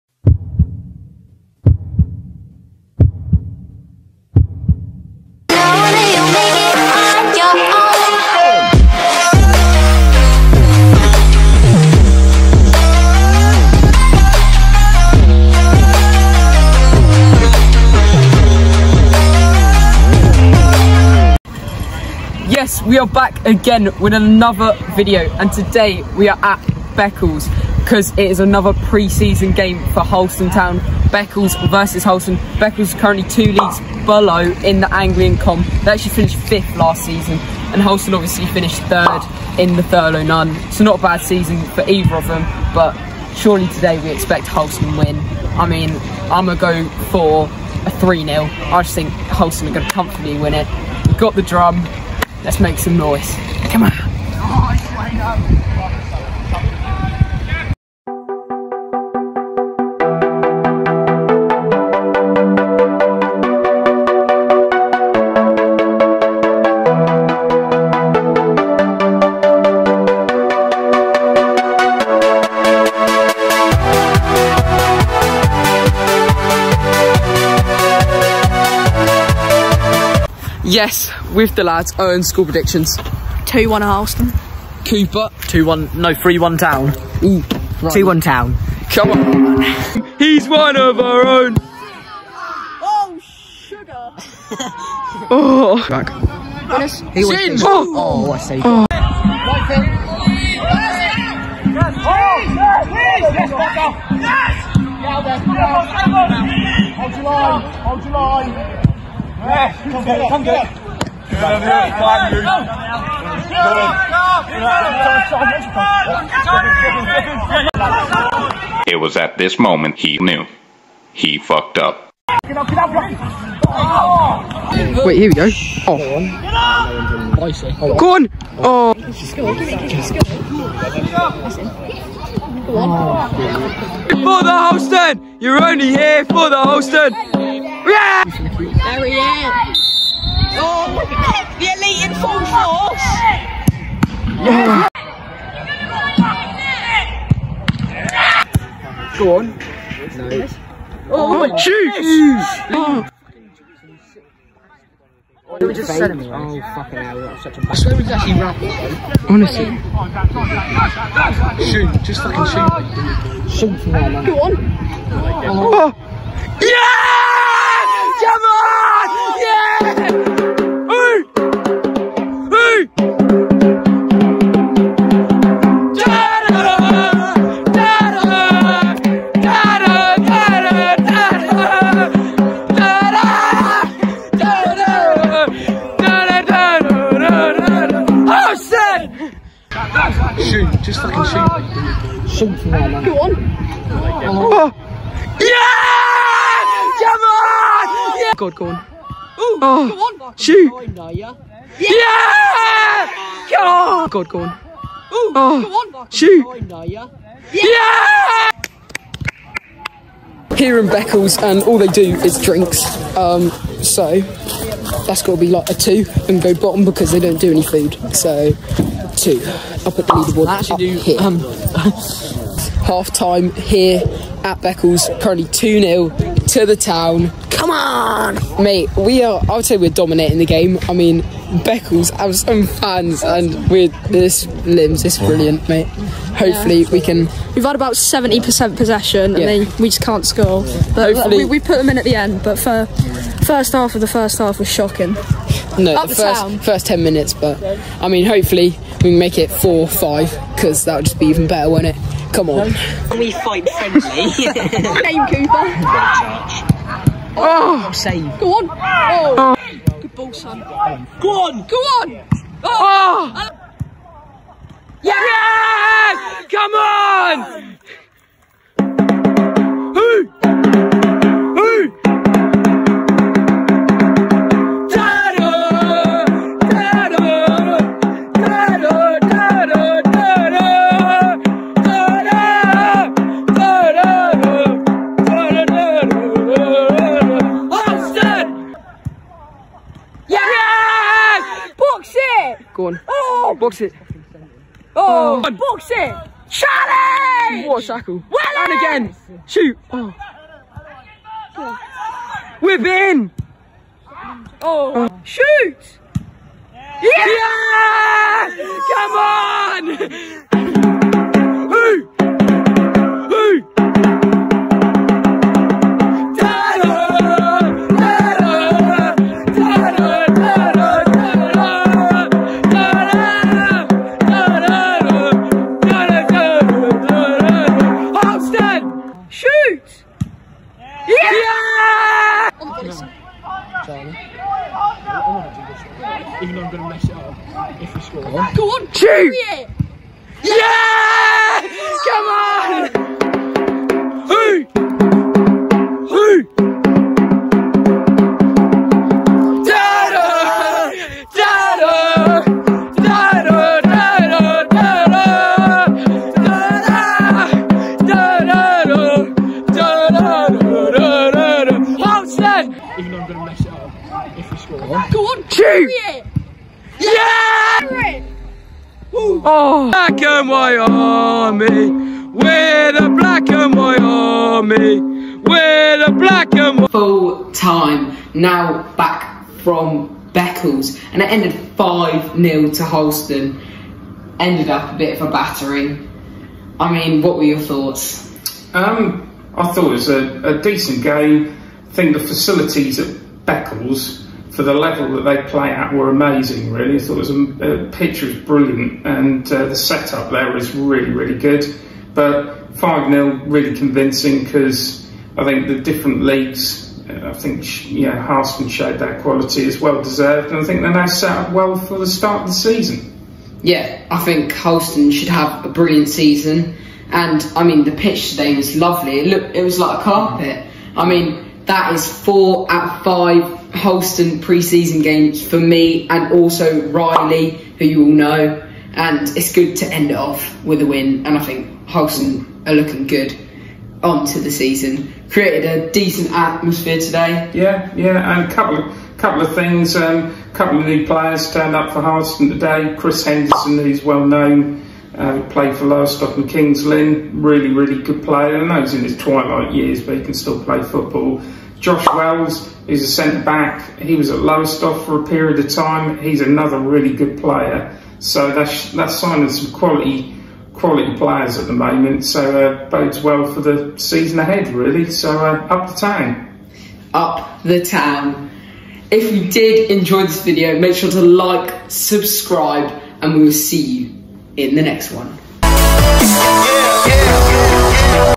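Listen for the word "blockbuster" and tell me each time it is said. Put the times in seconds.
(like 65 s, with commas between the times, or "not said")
not said.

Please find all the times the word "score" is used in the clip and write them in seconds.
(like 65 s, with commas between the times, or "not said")
240 s, 338 s.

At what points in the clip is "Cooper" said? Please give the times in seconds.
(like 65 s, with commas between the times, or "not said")
84 s, 255 s.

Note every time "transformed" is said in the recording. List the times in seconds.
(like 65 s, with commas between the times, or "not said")
not said.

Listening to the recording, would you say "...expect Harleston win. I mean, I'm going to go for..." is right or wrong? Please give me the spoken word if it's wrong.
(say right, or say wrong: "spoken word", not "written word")
right.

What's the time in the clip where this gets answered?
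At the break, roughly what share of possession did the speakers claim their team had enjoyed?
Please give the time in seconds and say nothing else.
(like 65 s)
237 s.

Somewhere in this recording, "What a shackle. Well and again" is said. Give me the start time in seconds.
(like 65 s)
297 s.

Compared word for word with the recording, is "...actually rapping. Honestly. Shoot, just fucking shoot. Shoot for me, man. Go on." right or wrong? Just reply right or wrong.
right.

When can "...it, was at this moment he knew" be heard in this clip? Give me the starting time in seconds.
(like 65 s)
118 s.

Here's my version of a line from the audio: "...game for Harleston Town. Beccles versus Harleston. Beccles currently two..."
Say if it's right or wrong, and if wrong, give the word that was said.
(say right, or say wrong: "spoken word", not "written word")
right.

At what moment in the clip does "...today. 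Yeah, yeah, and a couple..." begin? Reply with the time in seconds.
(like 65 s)
436 s.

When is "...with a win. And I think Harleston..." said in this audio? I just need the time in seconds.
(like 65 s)
430 s.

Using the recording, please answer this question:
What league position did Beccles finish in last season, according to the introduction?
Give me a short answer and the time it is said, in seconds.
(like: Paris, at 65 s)
fifth, at 36 s.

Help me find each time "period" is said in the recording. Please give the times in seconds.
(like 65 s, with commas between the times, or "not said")
455 s.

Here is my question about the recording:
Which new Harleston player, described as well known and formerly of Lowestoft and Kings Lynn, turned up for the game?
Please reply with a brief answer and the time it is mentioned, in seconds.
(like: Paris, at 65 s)
Chris Henderson, at 442 s.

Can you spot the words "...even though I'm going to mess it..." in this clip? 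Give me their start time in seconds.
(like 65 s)
336 s.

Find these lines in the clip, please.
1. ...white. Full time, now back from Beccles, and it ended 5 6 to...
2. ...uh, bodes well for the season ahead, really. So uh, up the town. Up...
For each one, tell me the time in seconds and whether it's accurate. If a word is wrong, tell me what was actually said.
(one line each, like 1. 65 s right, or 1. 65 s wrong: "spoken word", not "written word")
1. 376 s wrong: "0", not "6"
2. 462 s right.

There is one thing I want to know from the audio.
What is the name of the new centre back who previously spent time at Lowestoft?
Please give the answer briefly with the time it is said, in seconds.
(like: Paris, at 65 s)
Josh Wells, at 451 s.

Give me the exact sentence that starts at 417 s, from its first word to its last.
And I mean, the pitch today was lovely.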